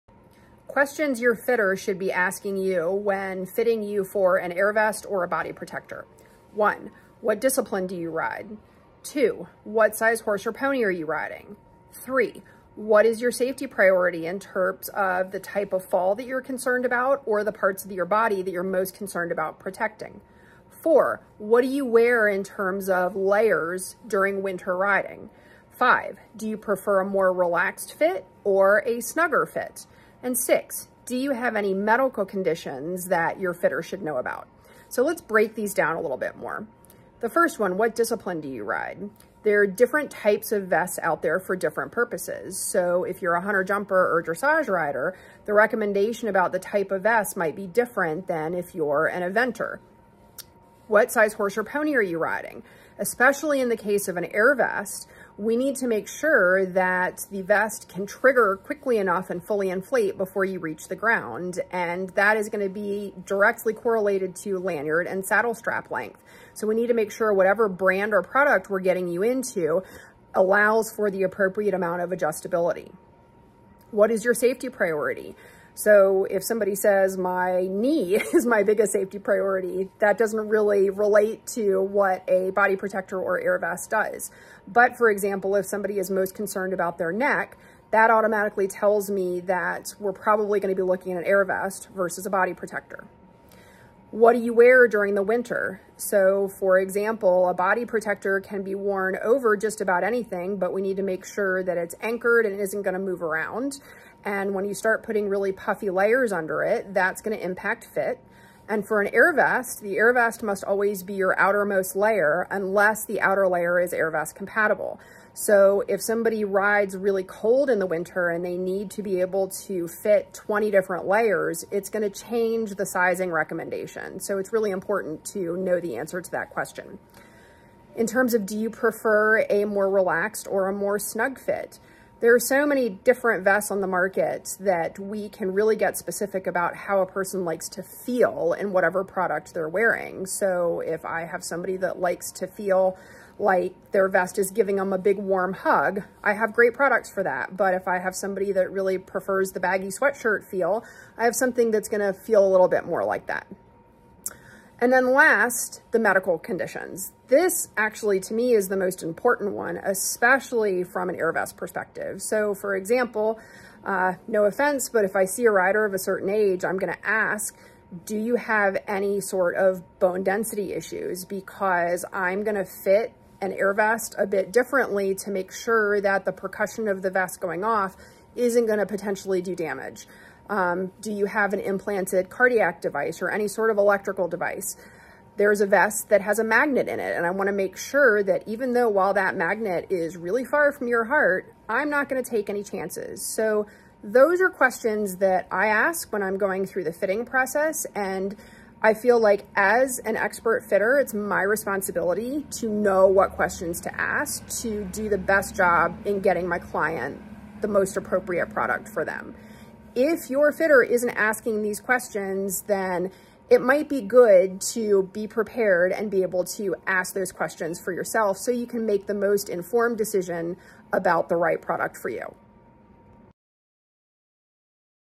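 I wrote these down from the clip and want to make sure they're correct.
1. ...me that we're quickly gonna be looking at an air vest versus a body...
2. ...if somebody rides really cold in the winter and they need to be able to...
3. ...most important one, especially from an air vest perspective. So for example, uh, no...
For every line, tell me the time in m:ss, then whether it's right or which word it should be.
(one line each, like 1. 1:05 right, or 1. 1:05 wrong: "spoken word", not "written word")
1. 1:29 wrong: "probably", not "quickly"
2. 1:55 right
3. 2:38 right.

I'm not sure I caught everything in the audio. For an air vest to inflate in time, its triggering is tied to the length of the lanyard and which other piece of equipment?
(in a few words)
saddle strap.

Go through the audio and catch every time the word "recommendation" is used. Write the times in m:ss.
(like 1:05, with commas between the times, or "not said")
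0:45, 2:03.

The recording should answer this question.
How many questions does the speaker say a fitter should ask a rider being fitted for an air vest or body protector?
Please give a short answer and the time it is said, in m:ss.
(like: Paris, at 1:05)
6, at 0:30.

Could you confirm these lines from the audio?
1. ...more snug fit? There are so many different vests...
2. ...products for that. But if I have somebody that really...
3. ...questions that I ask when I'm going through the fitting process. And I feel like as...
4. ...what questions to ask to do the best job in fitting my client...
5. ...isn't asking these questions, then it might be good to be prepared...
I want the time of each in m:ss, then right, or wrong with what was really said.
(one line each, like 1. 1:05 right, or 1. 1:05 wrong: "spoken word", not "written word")
1. 2:10 right
2. 2:26 right
3. 3:14 right
4. 3:23 wrong: "getting", not "fitting"
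5. 3:30 right.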